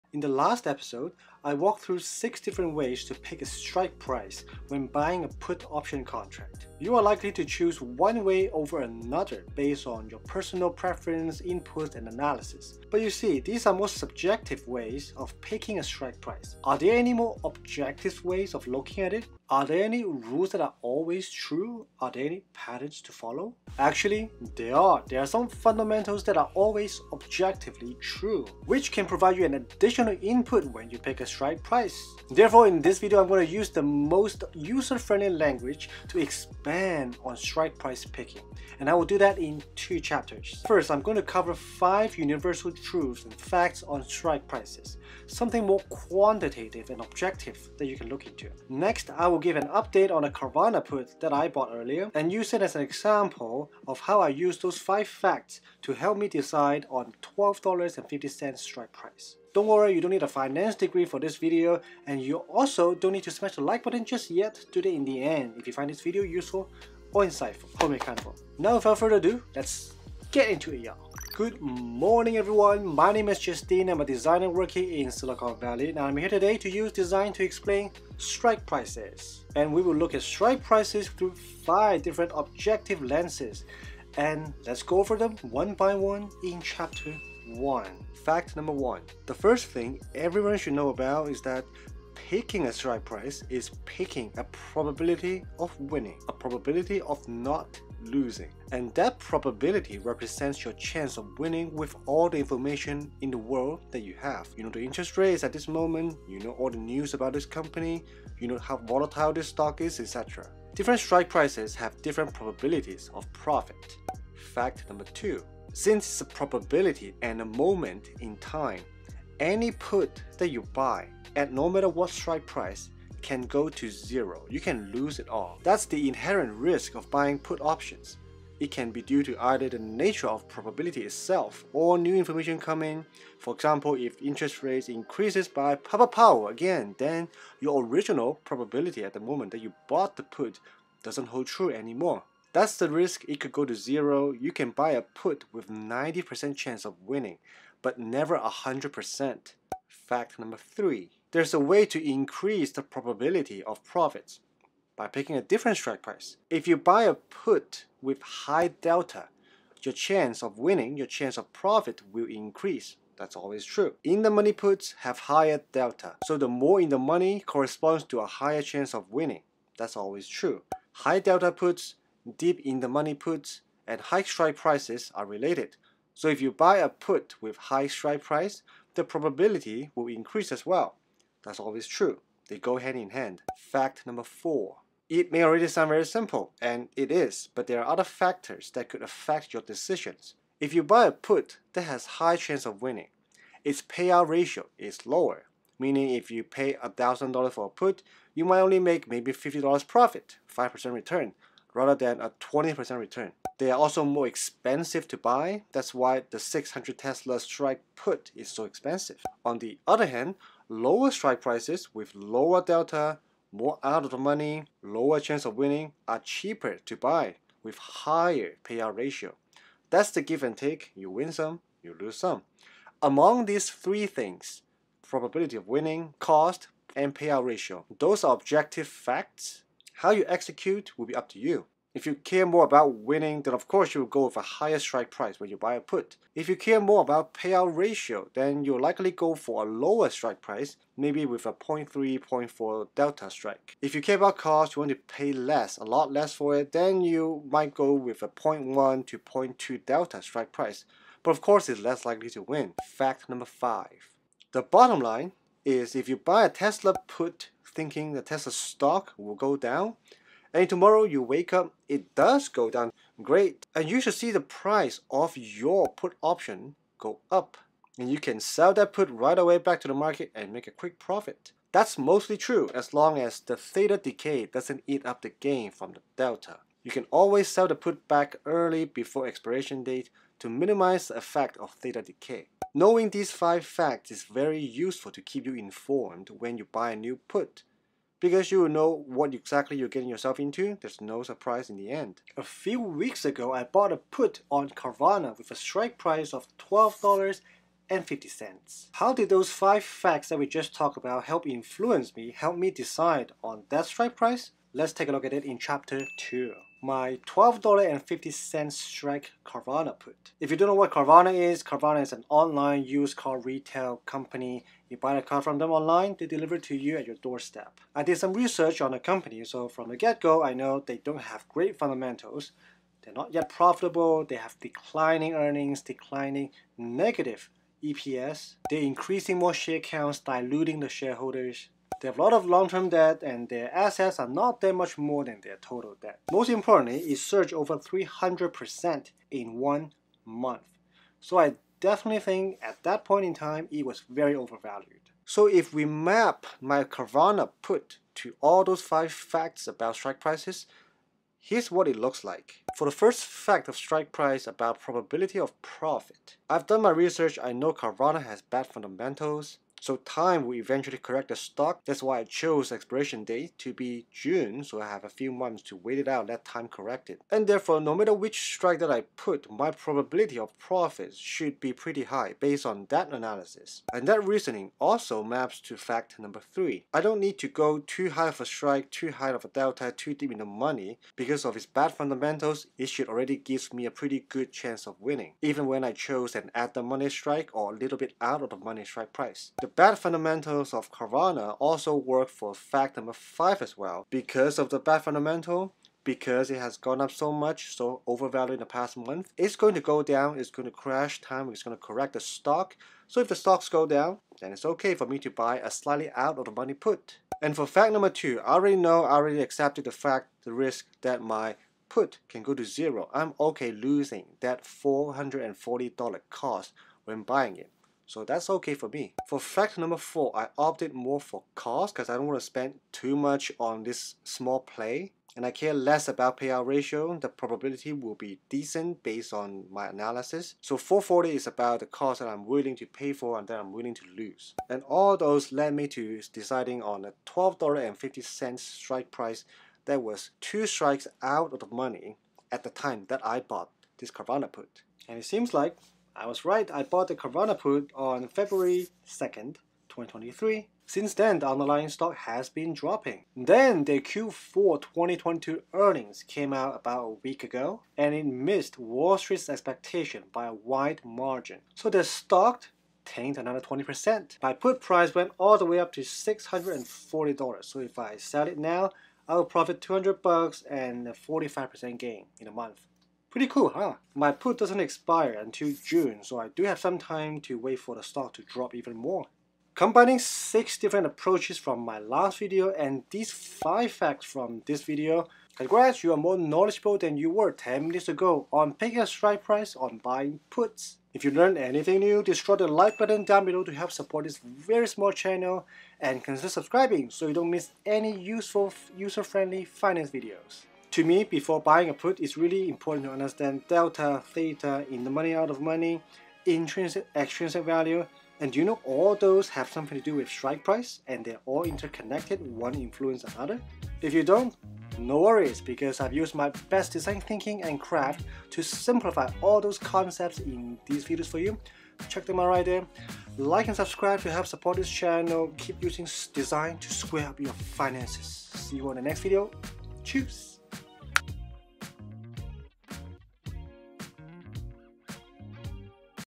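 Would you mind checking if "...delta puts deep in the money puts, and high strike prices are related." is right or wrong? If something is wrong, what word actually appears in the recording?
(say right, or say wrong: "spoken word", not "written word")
right.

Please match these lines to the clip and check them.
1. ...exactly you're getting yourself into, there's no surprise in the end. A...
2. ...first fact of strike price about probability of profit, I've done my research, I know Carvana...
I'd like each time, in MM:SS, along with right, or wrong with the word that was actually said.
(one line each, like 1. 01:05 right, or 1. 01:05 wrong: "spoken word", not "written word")
1. 04:49 right
2. 05:52 right.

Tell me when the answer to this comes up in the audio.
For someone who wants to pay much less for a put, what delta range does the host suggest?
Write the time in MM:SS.
04:08.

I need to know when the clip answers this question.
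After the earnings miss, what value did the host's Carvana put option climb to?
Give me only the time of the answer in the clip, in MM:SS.
07:46.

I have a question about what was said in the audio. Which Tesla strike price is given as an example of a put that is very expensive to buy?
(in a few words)
600.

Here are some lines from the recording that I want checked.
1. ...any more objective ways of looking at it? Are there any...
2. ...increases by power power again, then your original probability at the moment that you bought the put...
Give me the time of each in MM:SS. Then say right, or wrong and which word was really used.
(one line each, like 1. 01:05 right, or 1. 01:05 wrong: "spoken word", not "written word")
1. 00:16 right
2. 02:14 right.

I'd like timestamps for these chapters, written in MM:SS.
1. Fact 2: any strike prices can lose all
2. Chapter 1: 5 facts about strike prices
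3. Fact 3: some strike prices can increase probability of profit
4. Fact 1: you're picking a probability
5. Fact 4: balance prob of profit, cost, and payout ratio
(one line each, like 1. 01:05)
1. 01:54
2. 01:10
3. 02:29
4. 01:28
5. 03:04.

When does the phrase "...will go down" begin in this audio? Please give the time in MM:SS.
04:19.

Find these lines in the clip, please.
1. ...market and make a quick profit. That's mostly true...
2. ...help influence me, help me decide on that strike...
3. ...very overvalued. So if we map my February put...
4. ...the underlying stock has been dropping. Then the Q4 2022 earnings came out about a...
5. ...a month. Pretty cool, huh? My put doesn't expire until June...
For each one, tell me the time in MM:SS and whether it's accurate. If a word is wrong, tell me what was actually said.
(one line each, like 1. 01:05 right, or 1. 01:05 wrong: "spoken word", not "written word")
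1. 04:29 right
2. 05:01 right
3. 05:44 wrong: "Carvana", not "February"
4. 07:31 right
5. 07:52 right.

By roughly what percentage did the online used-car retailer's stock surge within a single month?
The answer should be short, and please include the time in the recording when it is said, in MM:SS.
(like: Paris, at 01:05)
300%, at 05:37.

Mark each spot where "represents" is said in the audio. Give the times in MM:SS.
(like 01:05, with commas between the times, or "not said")
01:39.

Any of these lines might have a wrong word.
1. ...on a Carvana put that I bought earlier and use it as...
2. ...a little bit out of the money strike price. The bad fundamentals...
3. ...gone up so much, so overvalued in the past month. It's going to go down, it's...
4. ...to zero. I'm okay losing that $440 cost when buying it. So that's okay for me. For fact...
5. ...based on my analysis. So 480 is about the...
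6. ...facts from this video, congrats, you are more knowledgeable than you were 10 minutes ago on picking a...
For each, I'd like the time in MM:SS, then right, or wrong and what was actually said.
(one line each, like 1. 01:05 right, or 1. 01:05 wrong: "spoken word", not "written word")
1. 00:50 right
2. 06:27 right
3. 06:36 right
4. 06:52 right
5. 07:09 wrong: "440", not "480"
6. 08:03 right.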